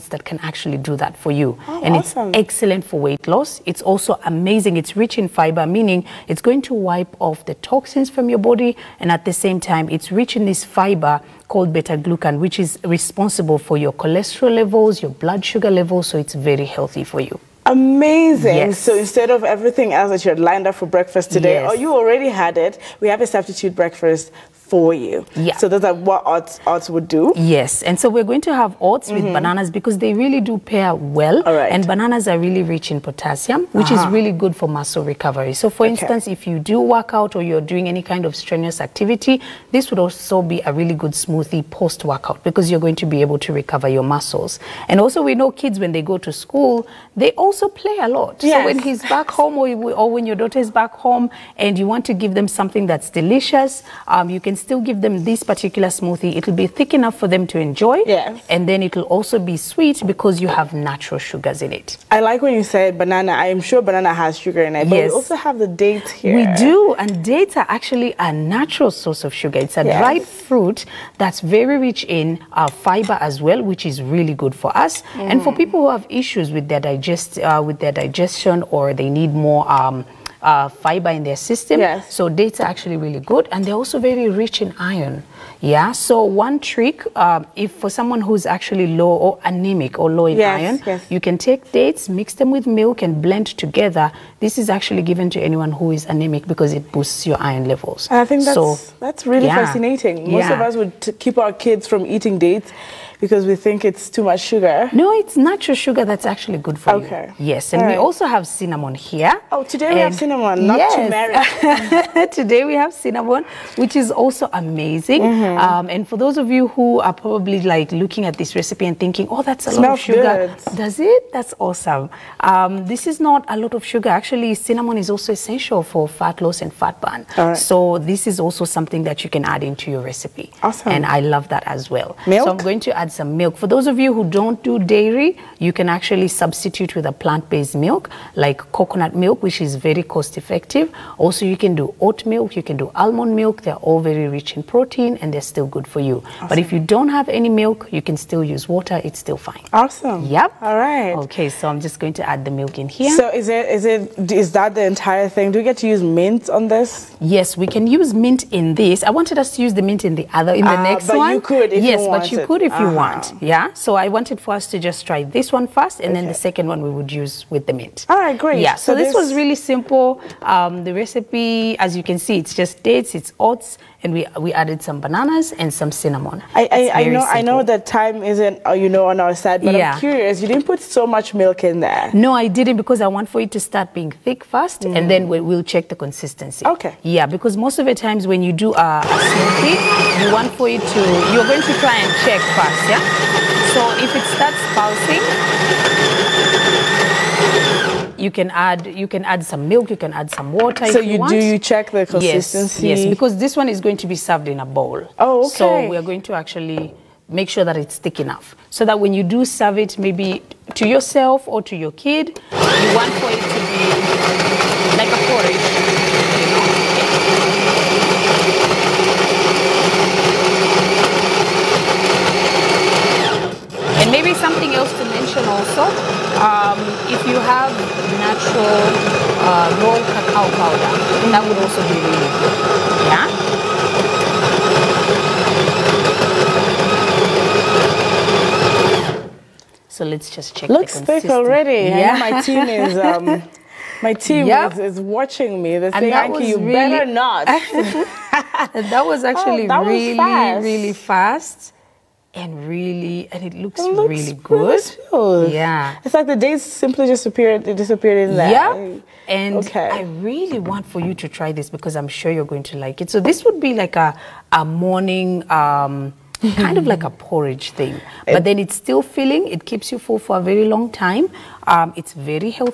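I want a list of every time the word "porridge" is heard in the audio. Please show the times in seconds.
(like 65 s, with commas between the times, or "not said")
215 s, 267 s.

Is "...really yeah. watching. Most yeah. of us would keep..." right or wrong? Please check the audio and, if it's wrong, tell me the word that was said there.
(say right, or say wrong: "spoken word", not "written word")
wrong: "fascinating", not "watching".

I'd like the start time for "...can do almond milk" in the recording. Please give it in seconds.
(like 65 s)
142 s.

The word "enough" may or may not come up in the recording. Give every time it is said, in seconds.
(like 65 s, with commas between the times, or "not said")
56 s, 208 s.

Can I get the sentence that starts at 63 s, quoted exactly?
I am sure banana has sugar in it.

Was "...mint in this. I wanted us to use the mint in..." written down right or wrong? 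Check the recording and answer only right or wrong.
right.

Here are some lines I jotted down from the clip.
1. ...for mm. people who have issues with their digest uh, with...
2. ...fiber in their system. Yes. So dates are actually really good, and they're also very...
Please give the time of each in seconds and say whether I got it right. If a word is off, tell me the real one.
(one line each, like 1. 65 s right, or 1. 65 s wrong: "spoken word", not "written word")
1. 75 s right
2. 80 s right.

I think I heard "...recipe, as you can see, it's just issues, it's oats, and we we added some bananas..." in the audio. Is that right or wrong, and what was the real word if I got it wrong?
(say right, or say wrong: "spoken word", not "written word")
wrong: "dates", not "issues".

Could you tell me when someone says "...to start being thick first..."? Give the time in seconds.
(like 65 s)
183 s.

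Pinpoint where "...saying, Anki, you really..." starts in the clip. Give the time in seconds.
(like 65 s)
245 s.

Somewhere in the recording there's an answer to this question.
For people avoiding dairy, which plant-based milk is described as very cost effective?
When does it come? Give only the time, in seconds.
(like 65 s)
138 s.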